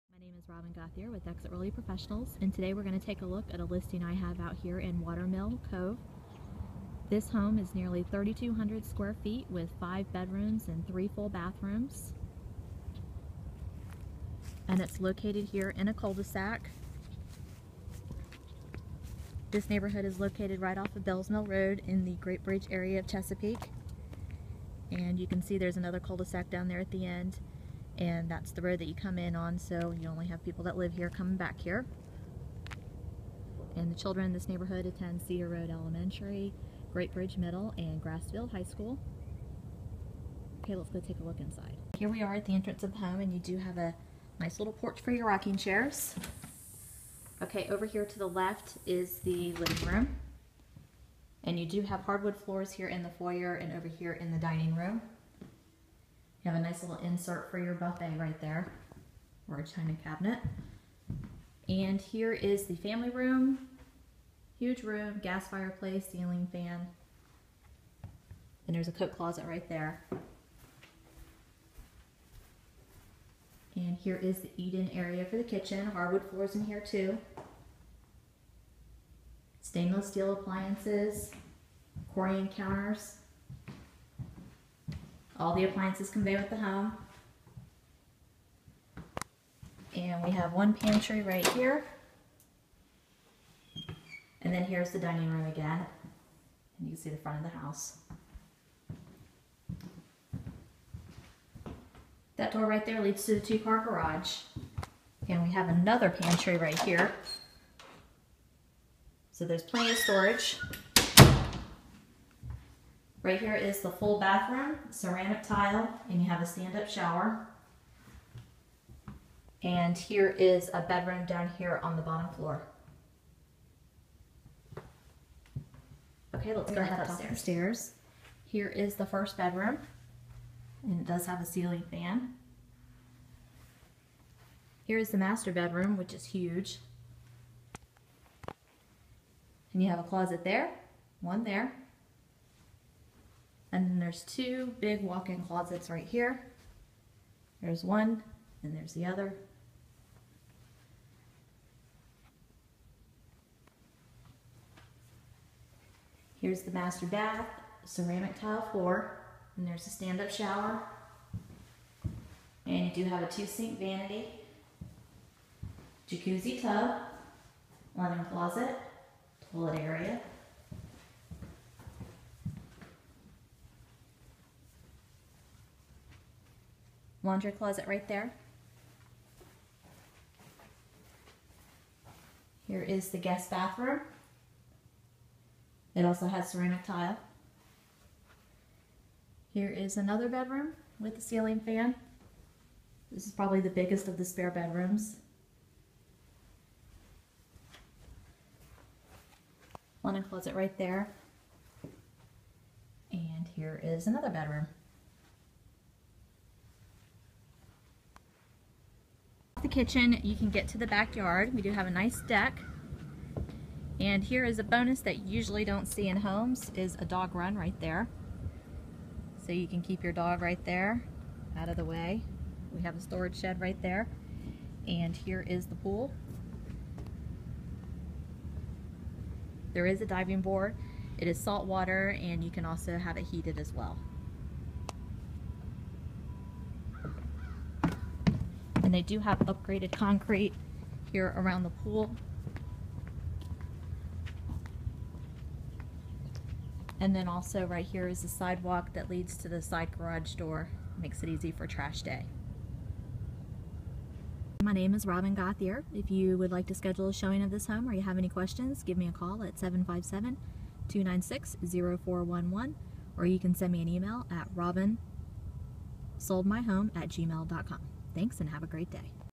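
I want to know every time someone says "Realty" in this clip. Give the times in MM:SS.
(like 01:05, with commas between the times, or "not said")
00:01.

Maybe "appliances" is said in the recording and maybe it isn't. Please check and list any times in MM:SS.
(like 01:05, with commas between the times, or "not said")
01:20, 01:25.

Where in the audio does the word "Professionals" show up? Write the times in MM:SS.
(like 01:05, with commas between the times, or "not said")
00:01.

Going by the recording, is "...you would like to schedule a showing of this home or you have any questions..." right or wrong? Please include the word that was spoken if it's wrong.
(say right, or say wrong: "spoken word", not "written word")
right.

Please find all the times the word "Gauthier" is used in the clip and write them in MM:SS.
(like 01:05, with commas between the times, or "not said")
00:00, 04:15.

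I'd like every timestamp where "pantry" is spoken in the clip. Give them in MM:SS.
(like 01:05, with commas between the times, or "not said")
01:30, 01:46.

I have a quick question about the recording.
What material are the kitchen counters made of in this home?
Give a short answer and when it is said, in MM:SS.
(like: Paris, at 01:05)
Corian, at 01:22.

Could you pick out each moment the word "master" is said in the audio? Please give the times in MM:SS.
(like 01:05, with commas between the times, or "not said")
02:15, 02:36.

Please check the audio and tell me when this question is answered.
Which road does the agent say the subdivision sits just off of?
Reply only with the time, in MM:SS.
00:21.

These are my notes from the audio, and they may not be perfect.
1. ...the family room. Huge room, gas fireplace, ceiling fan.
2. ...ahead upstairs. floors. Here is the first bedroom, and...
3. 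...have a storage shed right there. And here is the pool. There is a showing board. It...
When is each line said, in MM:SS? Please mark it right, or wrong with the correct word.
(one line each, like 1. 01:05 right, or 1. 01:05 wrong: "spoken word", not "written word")
1. 01:02 right
2. 02:06 wrong: "upstairs", not "floors"
3. 03:42 wrong: "diving", not "showing".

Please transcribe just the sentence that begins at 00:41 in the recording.
Here we are at the entrance of the home and you do have a nice little porch for your rocking chairs.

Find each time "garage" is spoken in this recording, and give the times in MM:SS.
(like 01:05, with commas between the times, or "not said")
01:43, 04:09.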